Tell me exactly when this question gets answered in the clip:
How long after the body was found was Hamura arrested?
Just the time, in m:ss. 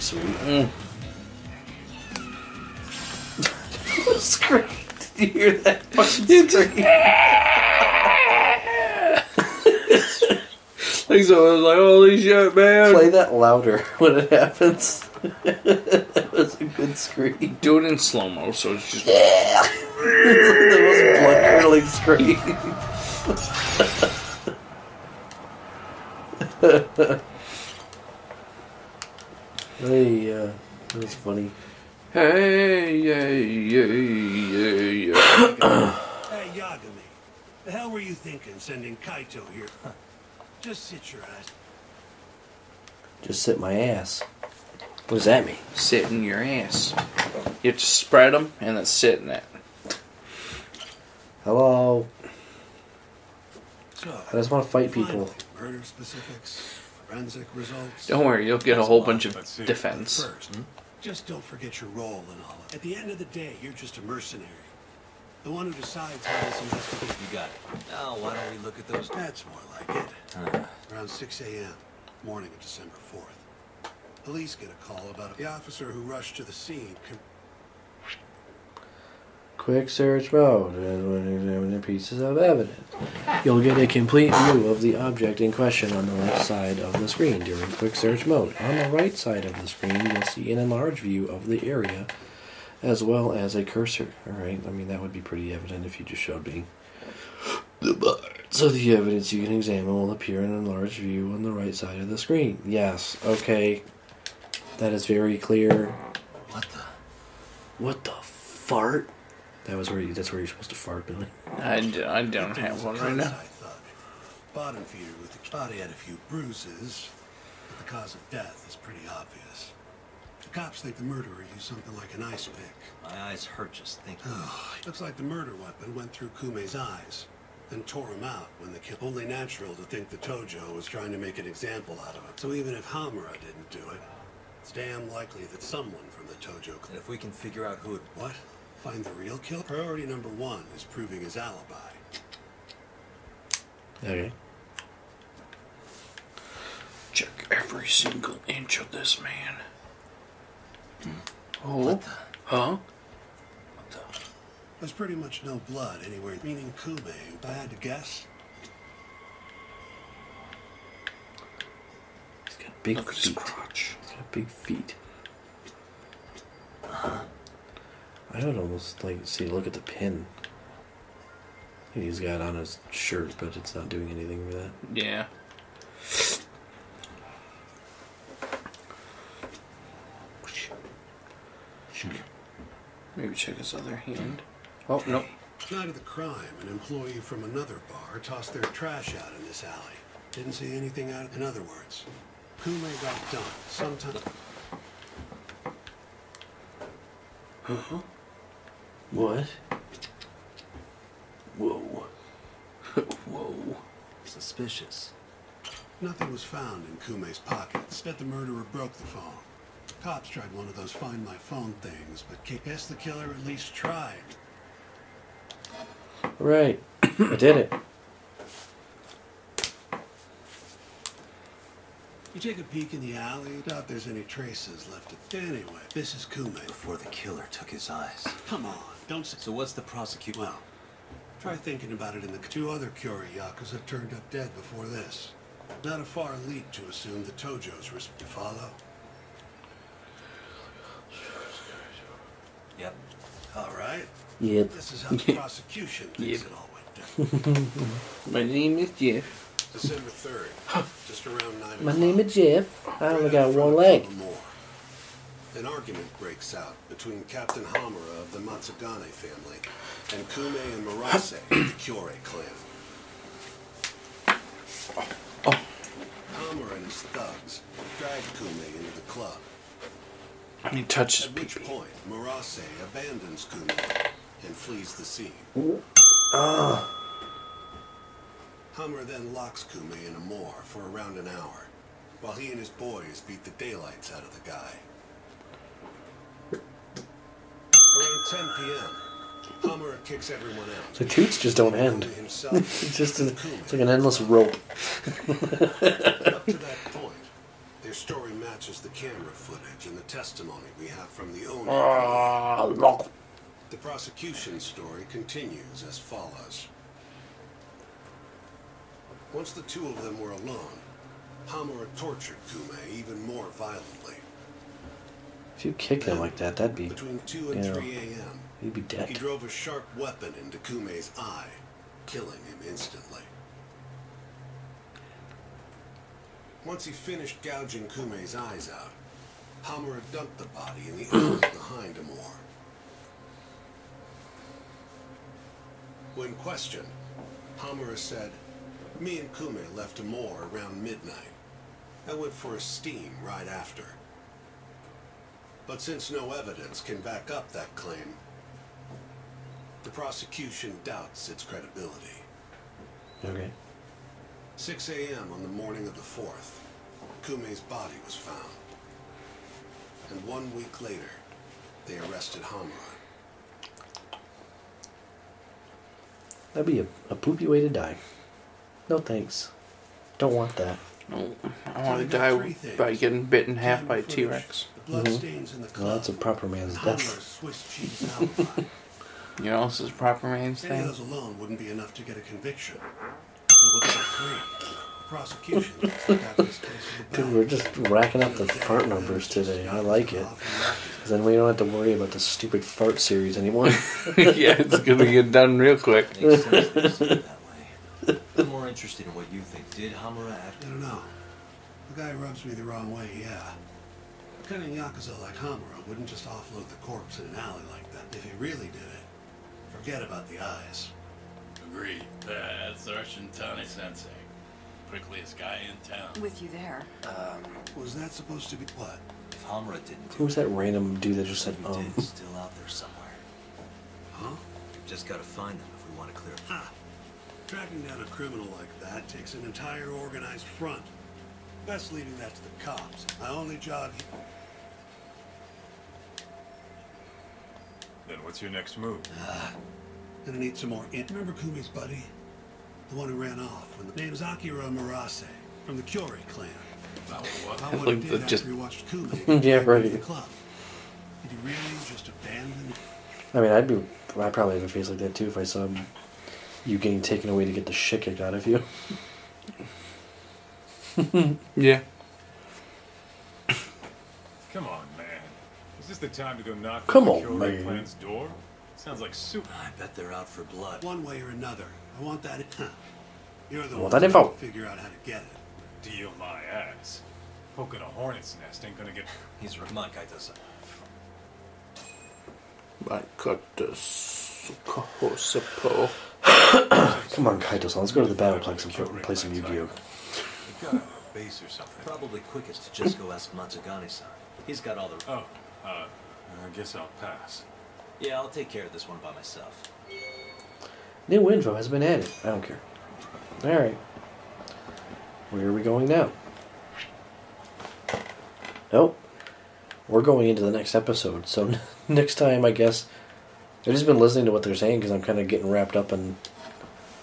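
6:00.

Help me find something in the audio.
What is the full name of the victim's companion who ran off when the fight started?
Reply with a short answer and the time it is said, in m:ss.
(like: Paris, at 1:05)
Akira Murase, at 7:24.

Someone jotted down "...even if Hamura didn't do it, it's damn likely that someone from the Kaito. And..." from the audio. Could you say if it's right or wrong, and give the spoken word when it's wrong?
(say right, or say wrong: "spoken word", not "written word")
wrong: "Tojo", not "Kaito".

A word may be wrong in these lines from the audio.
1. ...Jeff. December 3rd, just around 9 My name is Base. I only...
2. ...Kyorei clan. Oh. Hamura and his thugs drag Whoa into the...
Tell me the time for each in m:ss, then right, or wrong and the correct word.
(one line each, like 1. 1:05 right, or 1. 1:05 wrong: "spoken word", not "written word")
1. 4:08 wrong: "Jeff", not "Base"
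2. 4:21 wrong: "Kume", not "Whoa".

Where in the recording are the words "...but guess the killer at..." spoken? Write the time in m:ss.
3:32.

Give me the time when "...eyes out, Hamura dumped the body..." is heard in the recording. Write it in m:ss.
5:28.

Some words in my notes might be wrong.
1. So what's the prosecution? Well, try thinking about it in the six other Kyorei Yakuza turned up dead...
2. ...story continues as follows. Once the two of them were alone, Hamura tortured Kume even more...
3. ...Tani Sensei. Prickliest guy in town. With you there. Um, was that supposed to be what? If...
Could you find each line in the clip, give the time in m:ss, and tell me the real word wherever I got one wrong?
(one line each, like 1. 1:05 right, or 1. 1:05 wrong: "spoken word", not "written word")
1. 3:49 wrong: "two", not "six"
2. 5:04 right
3. 6:53 right.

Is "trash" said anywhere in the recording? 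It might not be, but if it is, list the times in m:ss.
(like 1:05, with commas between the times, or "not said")
3:08.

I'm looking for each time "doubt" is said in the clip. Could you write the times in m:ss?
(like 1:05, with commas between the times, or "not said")
3:43, 5:50.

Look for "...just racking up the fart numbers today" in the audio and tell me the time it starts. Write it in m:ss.
6:27.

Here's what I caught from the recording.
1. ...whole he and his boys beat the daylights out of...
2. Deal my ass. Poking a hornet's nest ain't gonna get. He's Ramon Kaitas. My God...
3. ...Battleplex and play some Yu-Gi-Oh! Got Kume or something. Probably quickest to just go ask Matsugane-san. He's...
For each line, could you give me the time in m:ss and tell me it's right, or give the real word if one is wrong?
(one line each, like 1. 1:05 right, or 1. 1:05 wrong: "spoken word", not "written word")
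1. 4:42 wrong: "while", not "whole"
2. 7:55 right
3. 8:08 wrong: "Base", not "Kume".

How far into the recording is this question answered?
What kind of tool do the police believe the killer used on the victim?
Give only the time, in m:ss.
2:02.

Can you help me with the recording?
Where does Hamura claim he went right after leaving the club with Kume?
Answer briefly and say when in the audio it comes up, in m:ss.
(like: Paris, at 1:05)
a steam, at 5:42.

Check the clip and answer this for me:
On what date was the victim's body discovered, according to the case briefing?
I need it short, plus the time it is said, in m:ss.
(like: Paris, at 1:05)
December 4th, at 1:12.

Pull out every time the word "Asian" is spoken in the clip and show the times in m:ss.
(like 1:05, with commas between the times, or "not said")
not said.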